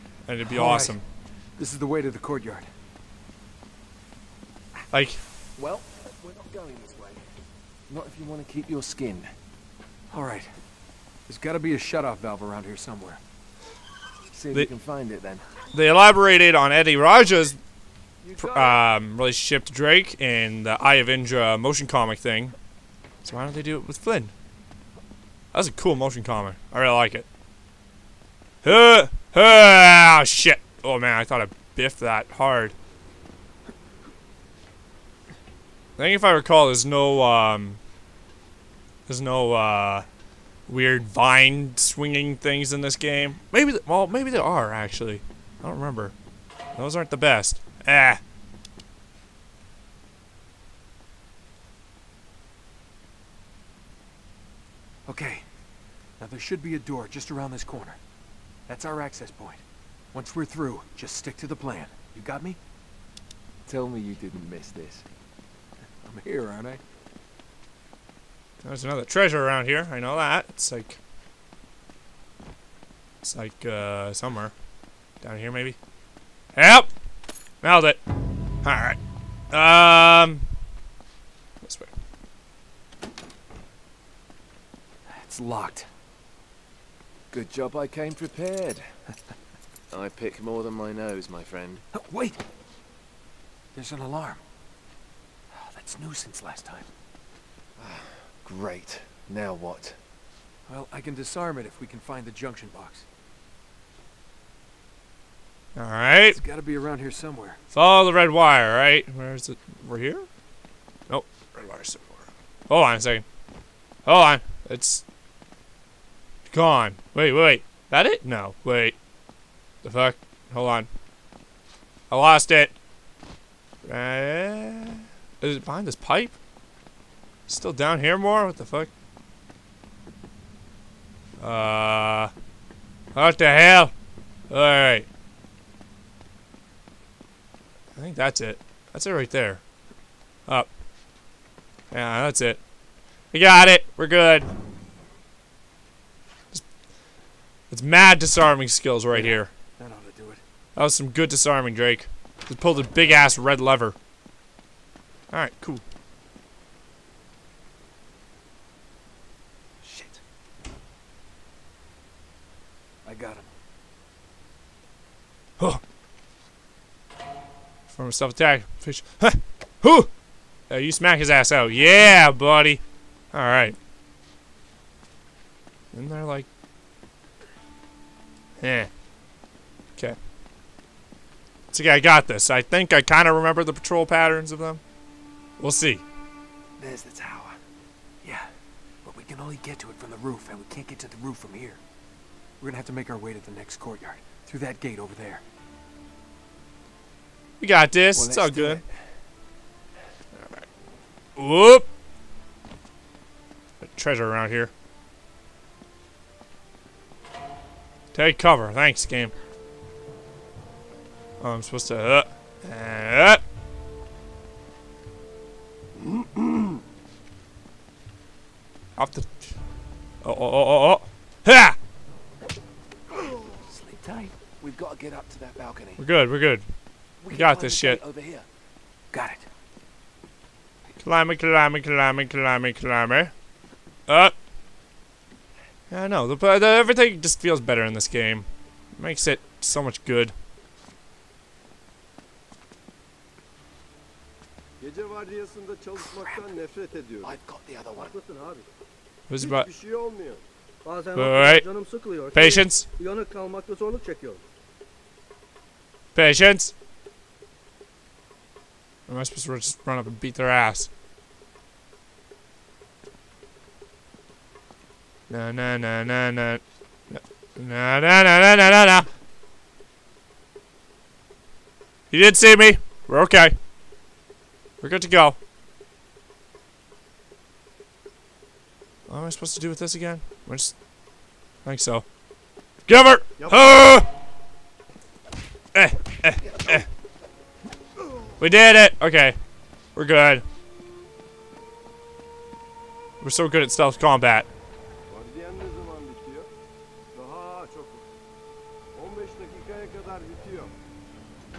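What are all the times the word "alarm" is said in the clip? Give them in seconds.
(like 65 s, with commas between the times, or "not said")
93 s.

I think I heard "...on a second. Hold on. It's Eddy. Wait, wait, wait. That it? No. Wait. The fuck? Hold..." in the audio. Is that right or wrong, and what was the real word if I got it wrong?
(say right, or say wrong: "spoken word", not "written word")
wrong: "Gone", not "Eddy".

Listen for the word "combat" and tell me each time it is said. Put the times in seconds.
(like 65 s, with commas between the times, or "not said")
293 s.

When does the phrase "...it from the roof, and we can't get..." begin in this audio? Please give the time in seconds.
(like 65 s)
189 s.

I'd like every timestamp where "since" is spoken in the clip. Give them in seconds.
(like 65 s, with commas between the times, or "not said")
96 s.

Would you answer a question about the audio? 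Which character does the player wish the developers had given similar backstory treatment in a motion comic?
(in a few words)
Flynn.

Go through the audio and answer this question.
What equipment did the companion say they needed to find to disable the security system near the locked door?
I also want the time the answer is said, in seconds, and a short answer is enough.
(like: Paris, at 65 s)
junction box, at 102 s.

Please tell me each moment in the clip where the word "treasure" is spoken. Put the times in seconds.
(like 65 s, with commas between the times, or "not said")
69 s, 203 s.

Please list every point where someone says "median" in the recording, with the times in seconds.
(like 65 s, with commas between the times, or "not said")
not said.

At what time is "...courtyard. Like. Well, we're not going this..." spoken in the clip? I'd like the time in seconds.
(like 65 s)
2 s.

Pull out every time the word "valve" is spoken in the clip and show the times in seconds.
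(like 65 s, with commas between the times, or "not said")
12 s.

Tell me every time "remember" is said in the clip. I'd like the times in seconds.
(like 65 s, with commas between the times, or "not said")
45 s, 183 s.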